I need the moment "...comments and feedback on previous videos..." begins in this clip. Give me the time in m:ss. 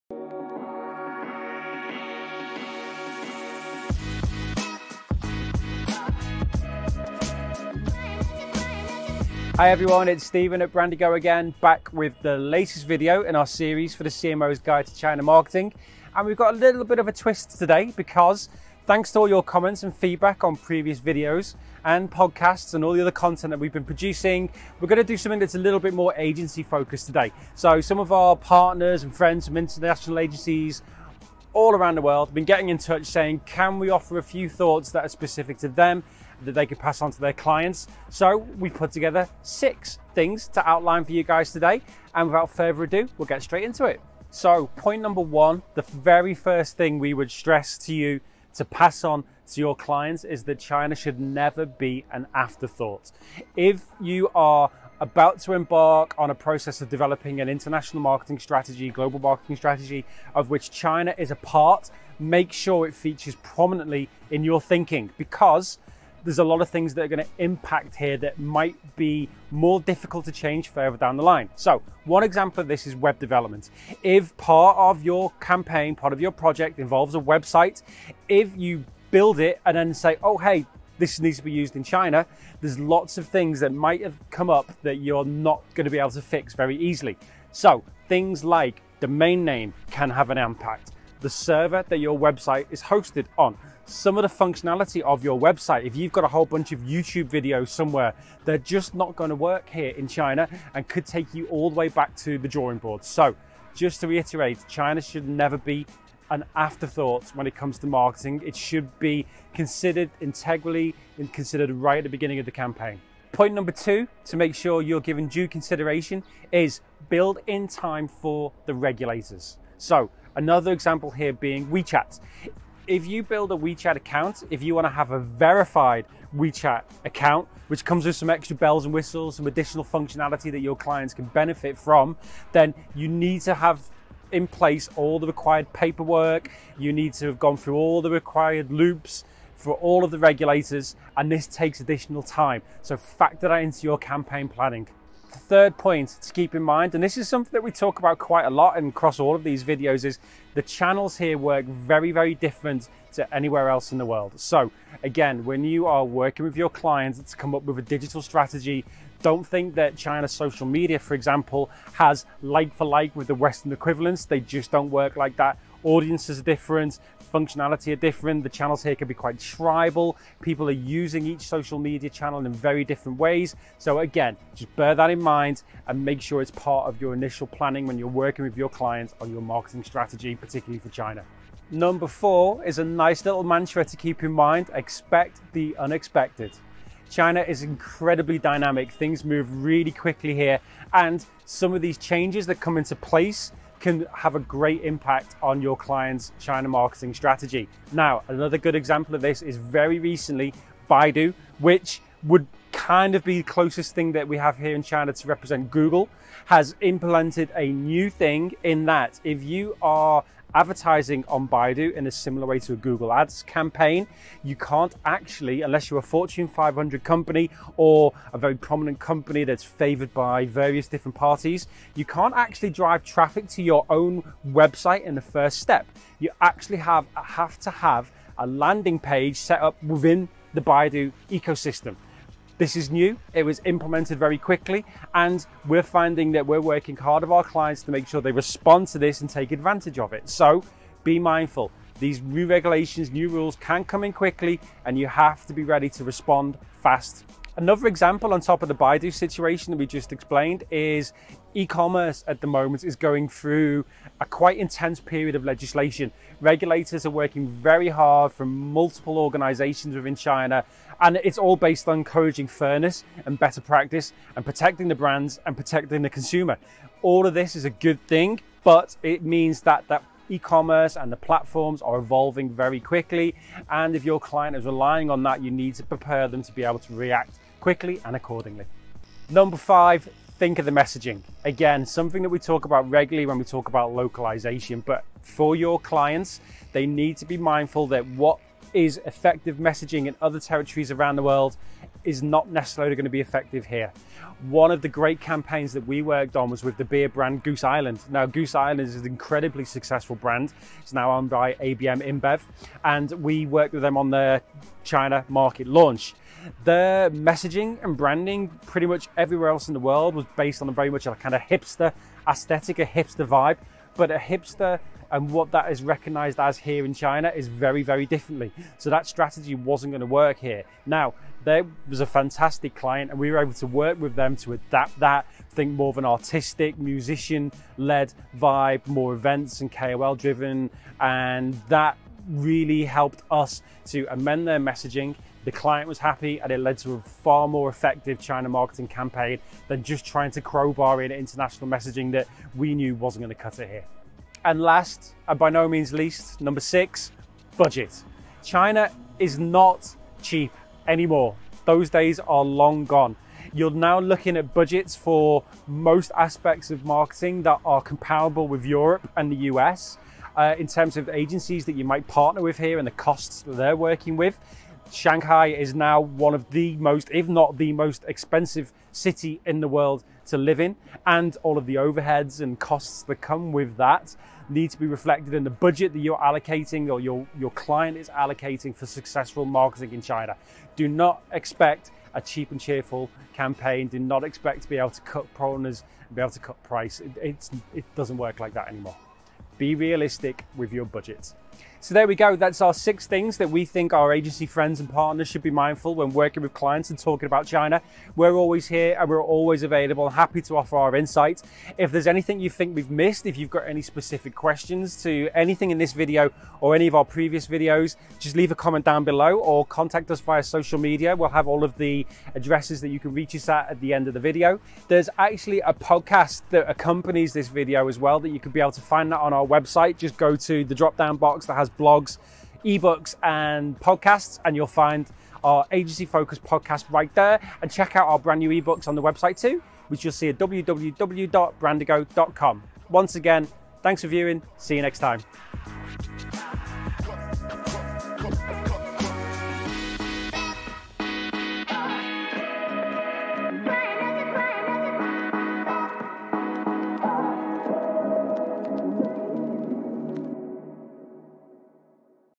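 0:19.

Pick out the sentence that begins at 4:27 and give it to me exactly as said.
All of this is a good thing, but it means that that e-commerce and the platforms are evolving very quickly.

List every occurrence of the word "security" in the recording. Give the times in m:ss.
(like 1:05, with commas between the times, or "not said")
not said.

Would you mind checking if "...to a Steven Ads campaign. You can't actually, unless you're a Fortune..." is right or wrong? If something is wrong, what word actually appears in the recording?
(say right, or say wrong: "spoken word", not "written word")
wrong: "Google", not "Steven".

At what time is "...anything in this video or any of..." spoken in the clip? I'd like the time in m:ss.
6:45.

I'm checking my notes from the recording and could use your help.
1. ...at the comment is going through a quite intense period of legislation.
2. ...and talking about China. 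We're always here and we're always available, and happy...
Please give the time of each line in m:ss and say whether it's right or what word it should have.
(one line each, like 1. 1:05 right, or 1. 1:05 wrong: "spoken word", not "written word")
1. 4:12 wrong: "moment", not "comment"
2. 6:36 right.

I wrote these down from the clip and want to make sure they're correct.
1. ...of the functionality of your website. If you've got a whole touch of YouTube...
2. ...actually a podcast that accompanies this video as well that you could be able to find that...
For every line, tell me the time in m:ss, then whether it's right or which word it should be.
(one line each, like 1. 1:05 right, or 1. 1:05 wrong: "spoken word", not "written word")
1. 1:34 wrong: "bunch", not "touch"
2. 6:55 right.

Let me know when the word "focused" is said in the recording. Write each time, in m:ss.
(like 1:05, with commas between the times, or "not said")
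0:26, 7:06.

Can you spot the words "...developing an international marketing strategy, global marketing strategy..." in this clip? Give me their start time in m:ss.
0:56.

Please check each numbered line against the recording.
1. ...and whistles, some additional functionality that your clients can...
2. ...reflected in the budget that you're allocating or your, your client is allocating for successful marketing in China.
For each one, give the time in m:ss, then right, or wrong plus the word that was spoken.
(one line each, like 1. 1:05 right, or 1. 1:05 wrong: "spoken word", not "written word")
1. 2:08 right
2. 6:14 right.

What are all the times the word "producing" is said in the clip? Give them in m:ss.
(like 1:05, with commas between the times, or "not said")
0:23.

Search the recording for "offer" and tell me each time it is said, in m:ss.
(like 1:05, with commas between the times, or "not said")
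0:33, 6:40.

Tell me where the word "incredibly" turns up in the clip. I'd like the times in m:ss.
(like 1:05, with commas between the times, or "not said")
3:07, 4:59.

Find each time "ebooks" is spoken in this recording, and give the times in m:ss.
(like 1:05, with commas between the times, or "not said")
7:02, 7:08.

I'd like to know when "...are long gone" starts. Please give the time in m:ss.
5:52.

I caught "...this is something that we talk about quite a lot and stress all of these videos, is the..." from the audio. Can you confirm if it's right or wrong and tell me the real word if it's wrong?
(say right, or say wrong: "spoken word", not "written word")
wrong: "across", not "stress".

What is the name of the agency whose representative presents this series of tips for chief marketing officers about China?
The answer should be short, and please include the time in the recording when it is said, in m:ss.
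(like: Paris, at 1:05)
Brandigo, at 0:10.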